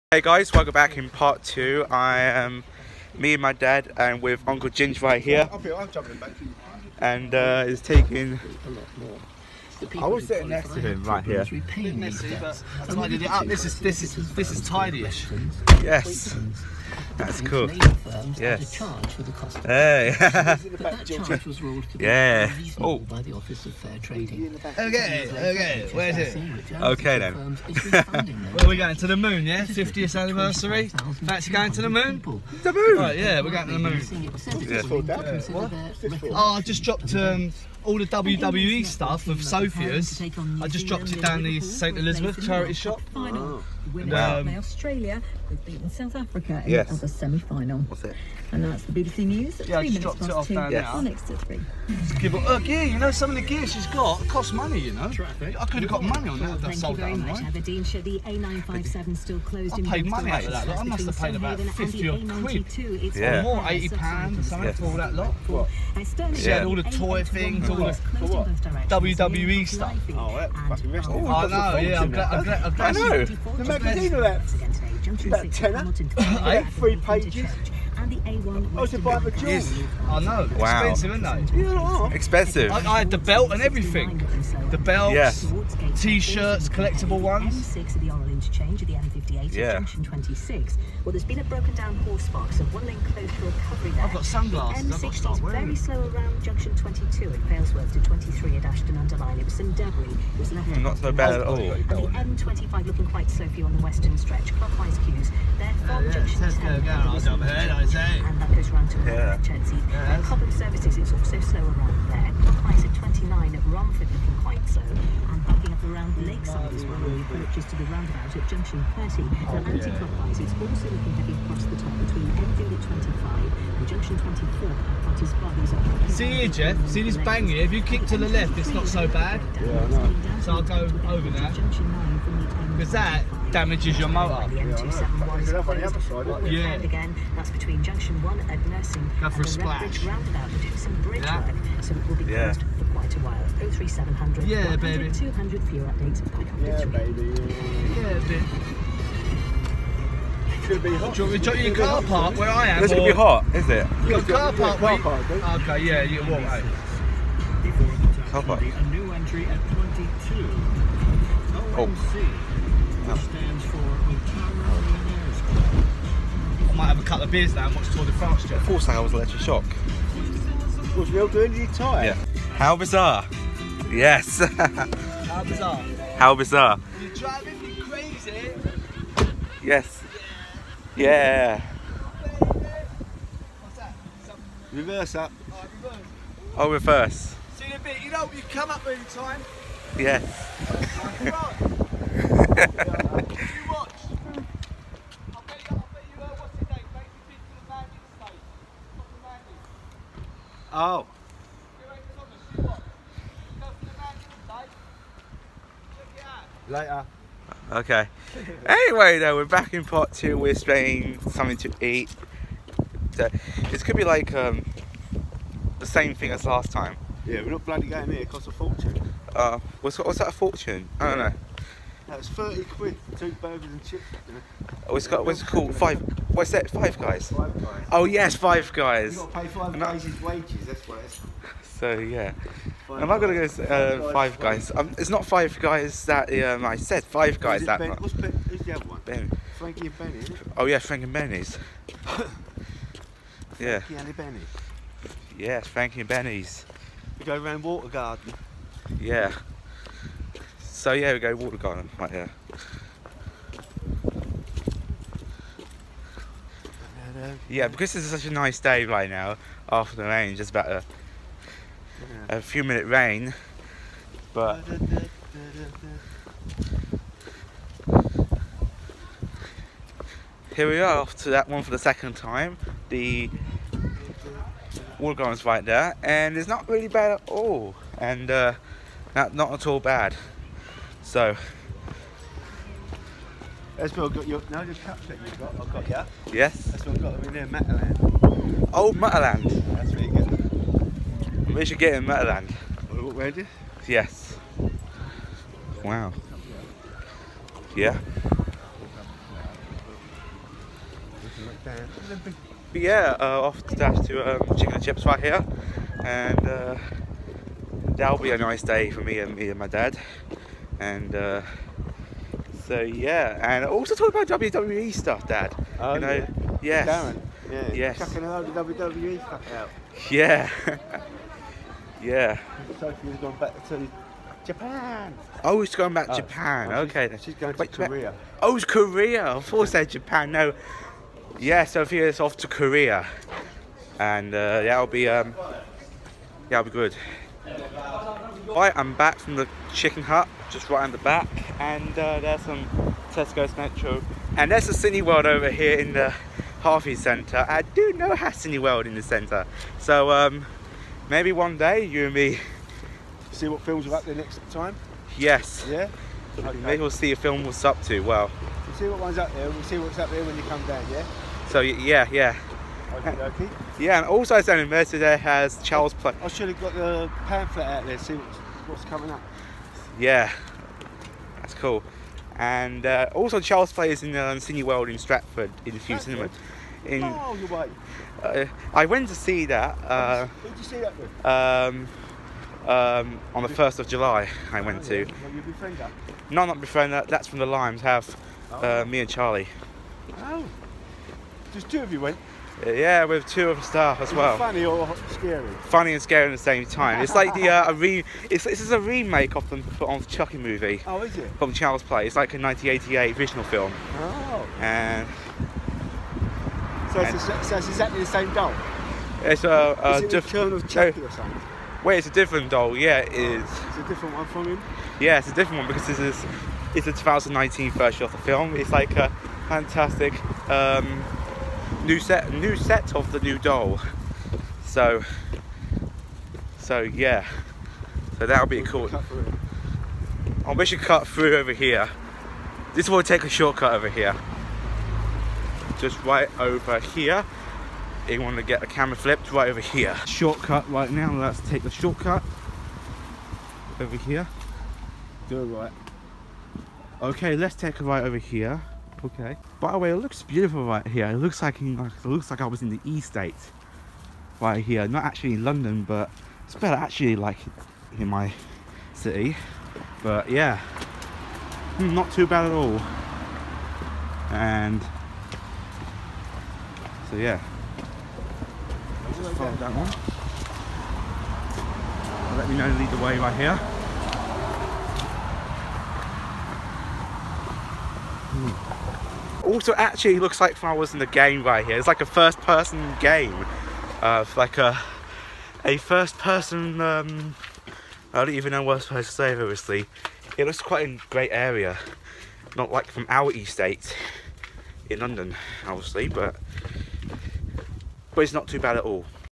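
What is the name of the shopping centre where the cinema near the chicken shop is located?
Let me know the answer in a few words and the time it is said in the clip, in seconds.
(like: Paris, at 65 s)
Harvey Centre, at 346 s.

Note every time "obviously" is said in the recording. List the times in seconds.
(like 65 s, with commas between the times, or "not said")
489 s, 495 s.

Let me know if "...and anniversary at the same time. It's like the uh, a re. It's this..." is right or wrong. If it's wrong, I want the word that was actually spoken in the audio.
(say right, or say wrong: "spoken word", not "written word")
wrong: "scary", not "anniversary".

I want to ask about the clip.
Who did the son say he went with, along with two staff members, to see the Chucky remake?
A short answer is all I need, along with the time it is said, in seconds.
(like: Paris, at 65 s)
Charlie, at 389 s.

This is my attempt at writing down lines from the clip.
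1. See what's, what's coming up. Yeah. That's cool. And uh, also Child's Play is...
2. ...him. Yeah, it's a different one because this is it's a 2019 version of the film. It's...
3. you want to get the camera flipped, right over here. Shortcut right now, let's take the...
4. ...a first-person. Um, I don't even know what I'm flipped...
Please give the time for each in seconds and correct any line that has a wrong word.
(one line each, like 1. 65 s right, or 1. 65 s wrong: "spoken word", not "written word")
1. 367 s right
2. 414 s right
3. 438 s right
4. 485 s wrong: "supposed", not "flipped".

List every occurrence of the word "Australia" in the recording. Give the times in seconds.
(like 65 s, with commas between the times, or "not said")
44 s.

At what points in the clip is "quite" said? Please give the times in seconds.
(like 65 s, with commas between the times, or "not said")
103 s, 114 s, 142 s, 490 s.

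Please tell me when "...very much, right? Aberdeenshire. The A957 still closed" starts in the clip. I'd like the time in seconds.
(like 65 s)
56 s.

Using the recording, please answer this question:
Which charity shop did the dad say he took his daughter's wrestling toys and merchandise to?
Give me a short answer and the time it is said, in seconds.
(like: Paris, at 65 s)
St Elizabeth, at 41 s.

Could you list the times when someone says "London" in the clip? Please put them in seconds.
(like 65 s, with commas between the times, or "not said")
455 s, 494 s.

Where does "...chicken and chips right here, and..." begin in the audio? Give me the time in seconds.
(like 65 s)
304 s.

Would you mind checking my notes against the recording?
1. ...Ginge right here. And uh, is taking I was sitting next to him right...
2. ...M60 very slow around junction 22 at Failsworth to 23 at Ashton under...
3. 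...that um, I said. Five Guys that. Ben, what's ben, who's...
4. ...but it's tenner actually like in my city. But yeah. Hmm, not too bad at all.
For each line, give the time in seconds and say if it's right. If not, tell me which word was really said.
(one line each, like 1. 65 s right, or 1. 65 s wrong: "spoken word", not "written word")
1. 4 s right
2. 95 s right
3. 236 s right
4. 455 s wrong: "better", not "tenner".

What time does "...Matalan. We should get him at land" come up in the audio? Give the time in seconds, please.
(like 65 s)
288 s.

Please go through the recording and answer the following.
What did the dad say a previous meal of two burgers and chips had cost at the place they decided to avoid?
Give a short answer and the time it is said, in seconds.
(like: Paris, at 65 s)
30 quid, at 222 s.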